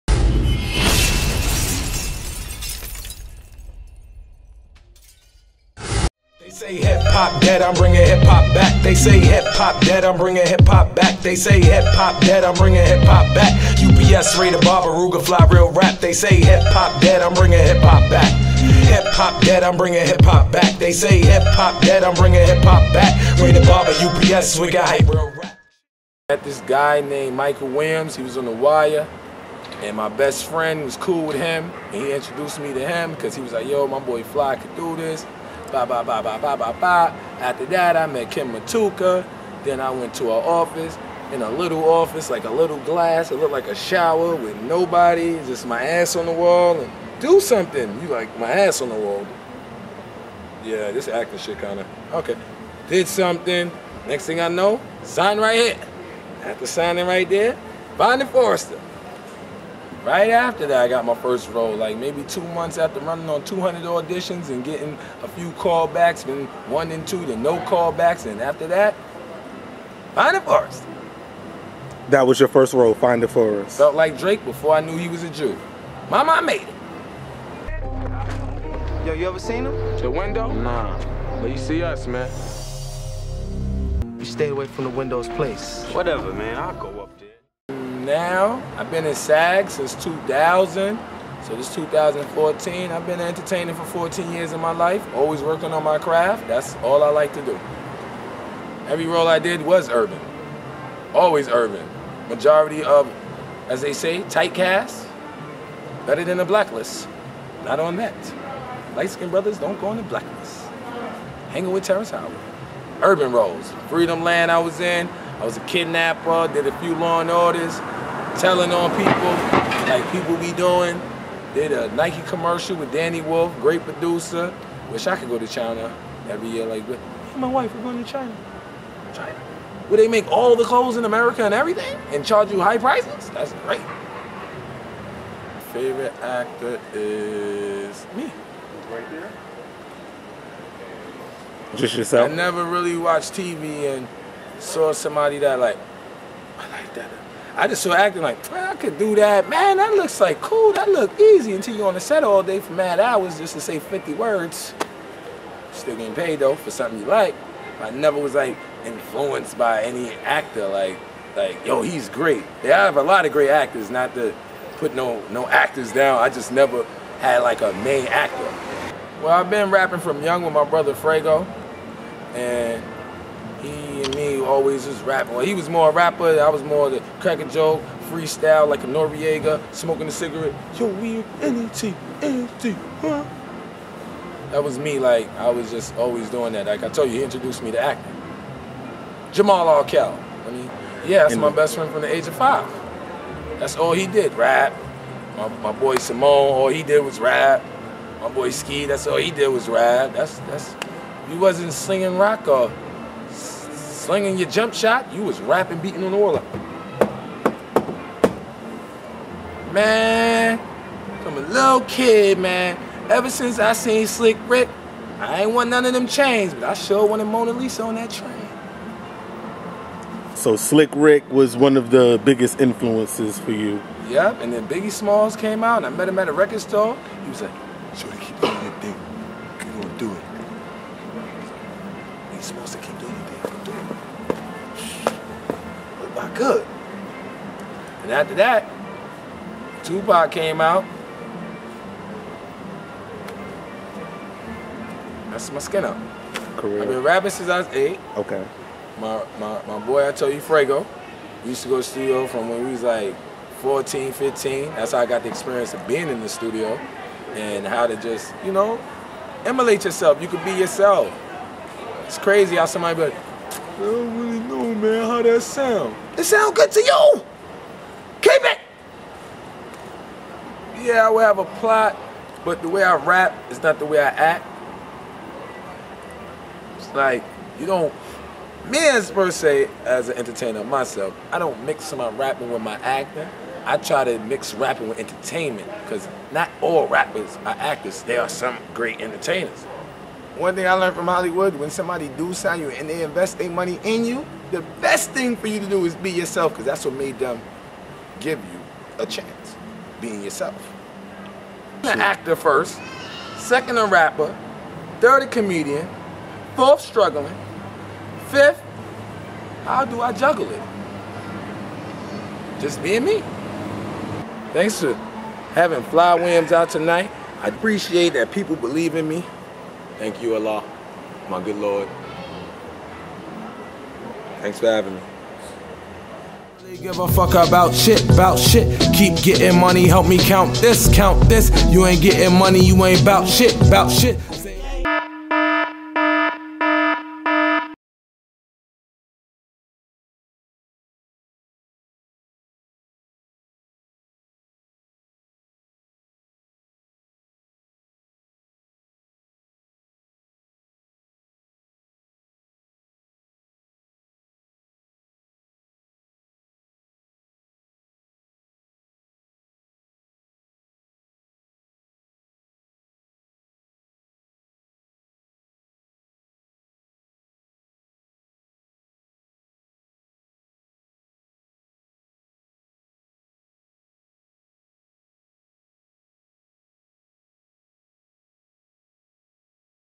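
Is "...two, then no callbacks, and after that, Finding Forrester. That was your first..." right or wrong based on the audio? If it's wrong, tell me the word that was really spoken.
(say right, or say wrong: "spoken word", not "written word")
right.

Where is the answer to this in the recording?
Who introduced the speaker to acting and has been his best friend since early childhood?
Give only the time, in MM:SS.
03:09.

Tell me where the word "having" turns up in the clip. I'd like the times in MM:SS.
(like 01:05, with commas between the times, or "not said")
05:15, 05:24.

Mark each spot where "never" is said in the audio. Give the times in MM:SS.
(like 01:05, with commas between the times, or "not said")
02:22, 02:37, 02:46.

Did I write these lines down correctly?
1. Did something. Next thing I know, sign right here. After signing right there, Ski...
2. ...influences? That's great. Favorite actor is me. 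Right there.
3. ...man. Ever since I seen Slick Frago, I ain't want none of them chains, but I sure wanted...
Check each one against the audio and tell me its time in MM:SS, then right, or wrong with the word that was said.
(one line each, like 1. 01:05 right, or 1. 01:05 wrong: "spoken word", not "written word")
1. 00:52 wrong: "Finding", not "Ski"
2. 02:12 wrong: "prices", not "influences"
3. 03:32 wrong: "Rick", not "Frago".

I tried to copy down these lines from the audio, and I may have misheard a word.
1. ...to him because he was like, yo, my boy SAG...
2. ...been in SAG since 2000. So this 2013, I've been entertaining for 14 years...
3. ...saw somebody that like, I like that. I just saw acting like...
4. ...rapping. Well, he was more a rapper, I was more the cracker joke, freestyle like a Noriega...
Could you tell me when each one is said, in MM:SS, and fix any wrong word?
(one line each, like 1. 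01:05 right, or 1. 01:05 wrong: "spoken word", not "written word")
1. 00:32 wrong: "Fly", not "SAG"
2. 01:28 wrong: "2014", not "2013"
3. 02:24 right
4. 02:55 right.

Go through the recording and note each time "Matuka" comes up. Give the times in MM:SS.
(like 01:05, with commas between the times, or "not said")
00:38.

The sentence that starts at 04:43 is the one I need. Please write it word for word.
I try to mix rapping with entertainment, because not all rappers are actors.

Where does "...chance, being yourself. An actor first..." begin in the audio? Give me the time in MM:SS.
04:59.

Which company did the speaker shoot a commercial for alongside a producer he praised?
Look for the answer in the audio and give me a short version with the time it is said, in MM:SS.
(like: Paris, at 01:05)
Nike, at 02:01.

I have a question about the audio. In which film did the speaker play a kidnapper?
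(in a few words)
Freedomland.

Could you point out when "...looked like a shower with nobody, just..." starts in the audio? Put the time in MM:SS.
00:43.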